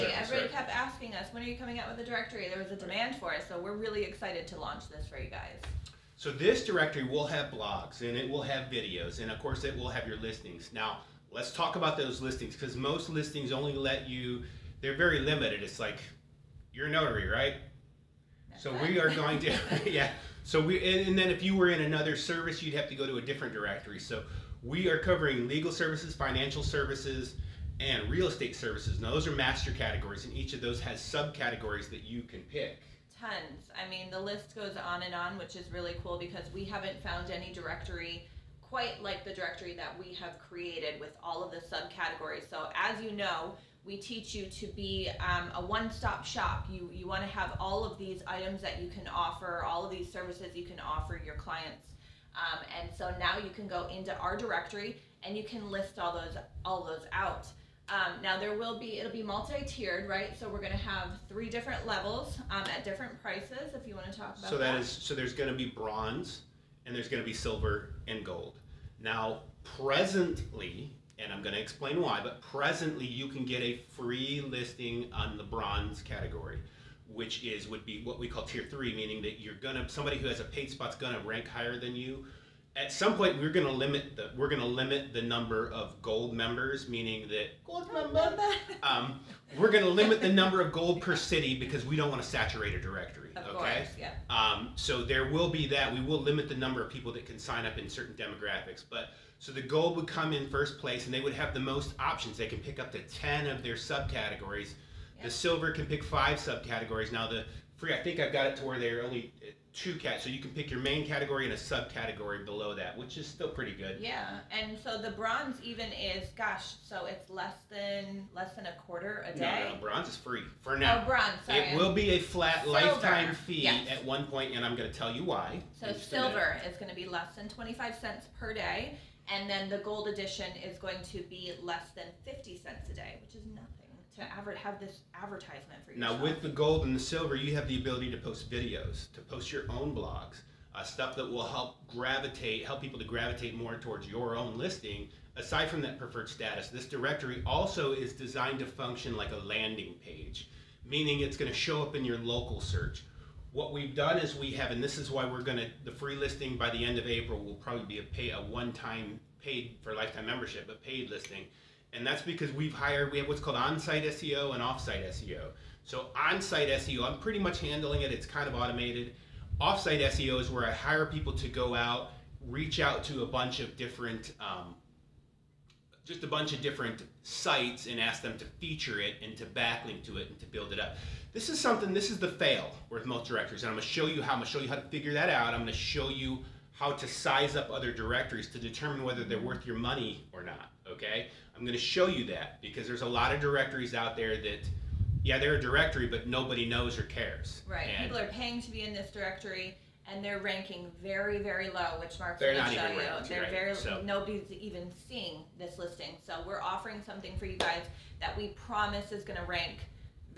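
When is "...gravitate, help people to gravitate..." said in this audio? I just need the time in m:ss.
2:21.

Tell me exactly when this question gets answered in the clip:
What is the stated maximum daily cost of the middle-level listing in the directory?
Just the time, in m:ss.
2:07.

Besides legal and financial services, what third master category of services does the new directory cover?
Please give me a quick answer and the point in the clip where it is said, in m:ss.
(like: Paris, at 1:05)
Real estate services, at 0:28.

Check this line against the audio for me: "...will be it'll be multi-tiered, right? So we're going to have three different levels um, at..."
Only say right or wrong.
right.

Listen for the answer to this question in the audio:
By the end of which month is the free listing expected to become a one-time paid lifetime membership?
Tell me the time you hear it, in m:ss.
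2:37.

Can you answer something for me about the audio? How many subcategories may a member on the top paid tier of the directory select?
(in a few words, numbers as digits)
10.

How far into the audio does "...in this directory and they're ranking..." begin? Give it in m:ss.
3:18.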